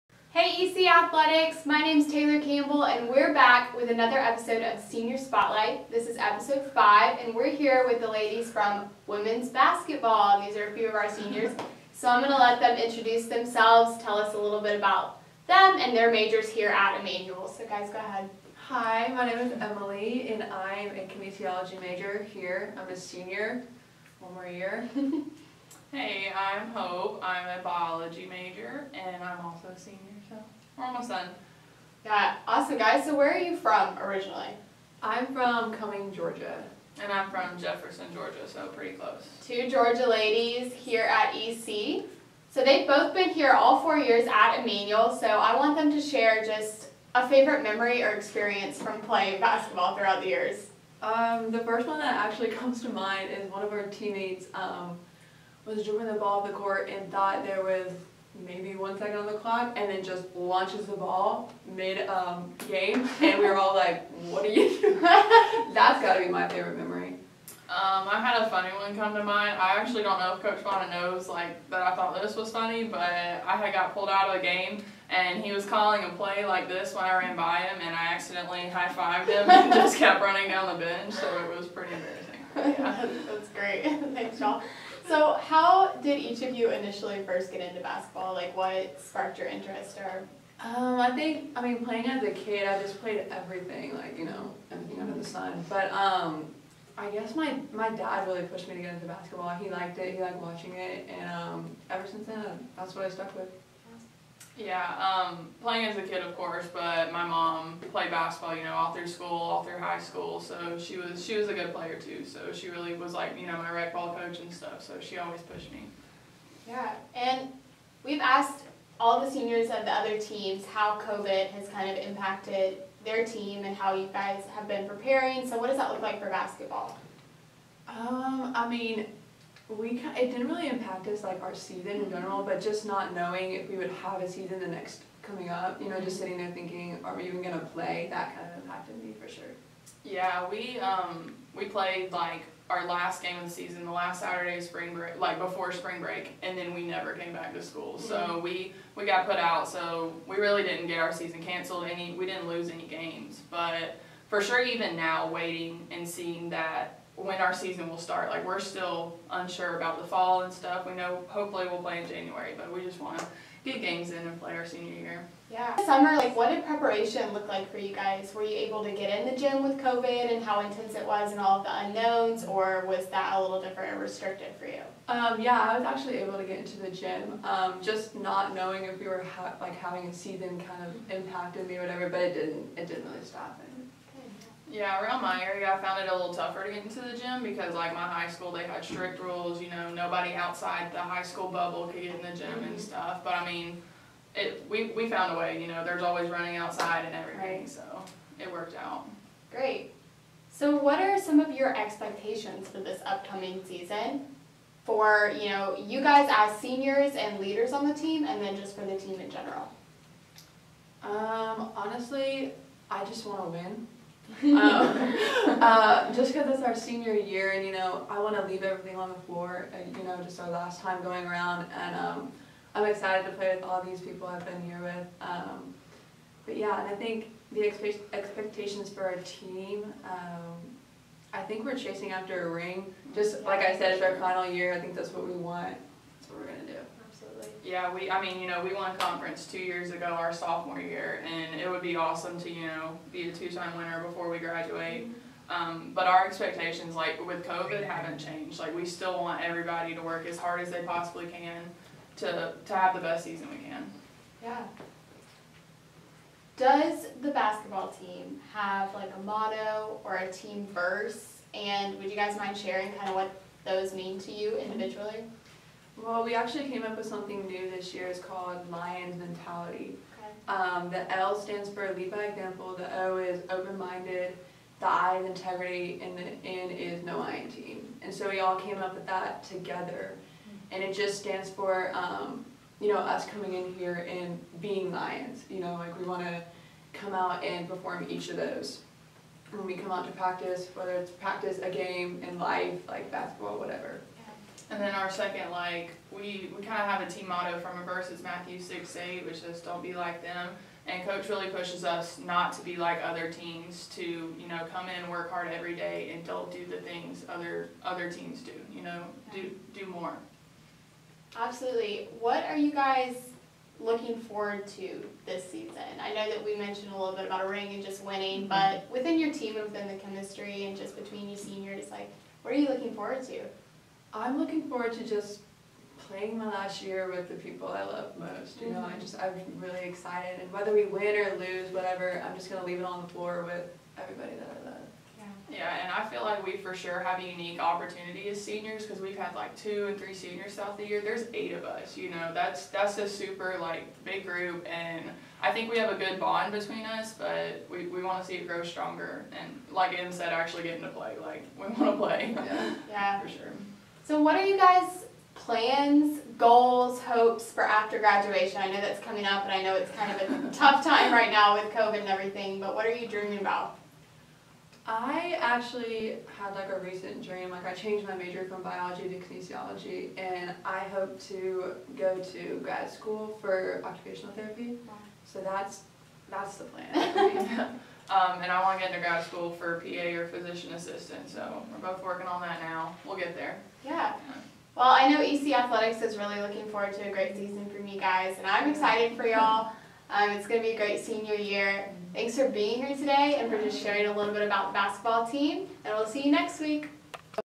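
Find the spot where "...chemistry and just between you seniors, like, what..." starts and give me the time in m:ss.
5:19.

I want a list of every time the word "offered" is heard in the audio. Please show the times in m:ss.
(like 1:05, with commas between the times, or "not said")
not said.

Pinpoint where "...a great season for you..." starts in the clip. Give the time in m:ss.
6:27.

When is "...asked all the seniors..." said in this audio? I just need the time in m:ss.
1:58.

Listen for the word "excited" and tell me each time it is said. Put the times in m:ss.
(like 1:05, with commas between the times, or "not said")
3:42, 5:29, 6:28.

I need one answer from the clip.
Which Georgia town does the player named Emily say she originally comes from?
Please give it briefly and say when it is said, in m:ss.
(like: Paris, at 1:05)
Cumming, Georgia, at 0:35.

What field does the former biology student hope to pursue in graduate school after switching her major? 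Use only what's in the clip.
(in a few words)
occupational therapy.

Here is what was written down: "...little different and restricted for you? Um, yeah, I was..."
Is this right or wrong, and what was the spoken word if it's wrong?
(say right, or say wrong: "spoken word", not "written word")
right.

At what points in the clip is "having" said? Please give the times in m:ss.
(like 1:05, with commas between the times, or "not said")
2:59.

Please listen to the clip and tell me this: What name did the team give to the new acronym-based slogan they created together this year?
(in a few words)
Lion's Mentality.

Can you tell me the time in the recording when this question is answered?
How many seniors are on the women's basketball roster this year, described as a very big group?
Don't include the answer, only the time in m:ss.
5:41.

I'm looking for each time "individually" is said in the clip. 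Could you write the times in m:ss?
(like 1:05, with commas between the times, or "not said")
4:24.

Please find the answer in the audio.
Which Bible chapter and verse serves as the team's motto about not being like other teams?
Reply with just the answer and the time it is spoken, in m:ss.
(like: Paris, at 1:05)
Matthew 6:8, at 4:58.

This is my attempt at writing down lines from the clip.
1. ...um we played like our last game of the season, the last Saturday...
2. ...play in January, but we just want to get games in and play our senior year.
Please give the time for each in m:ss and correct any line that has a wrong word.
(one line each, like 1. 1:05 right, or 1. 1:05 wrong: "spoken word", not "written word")
1. 2:20 right
2. 2:41 right.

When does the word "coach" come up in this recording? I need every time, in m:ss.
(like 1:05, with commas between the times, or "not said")
1:10, 1:54, 5:01.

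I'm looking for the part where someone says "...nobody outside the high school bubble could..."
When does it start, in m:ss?
3:09.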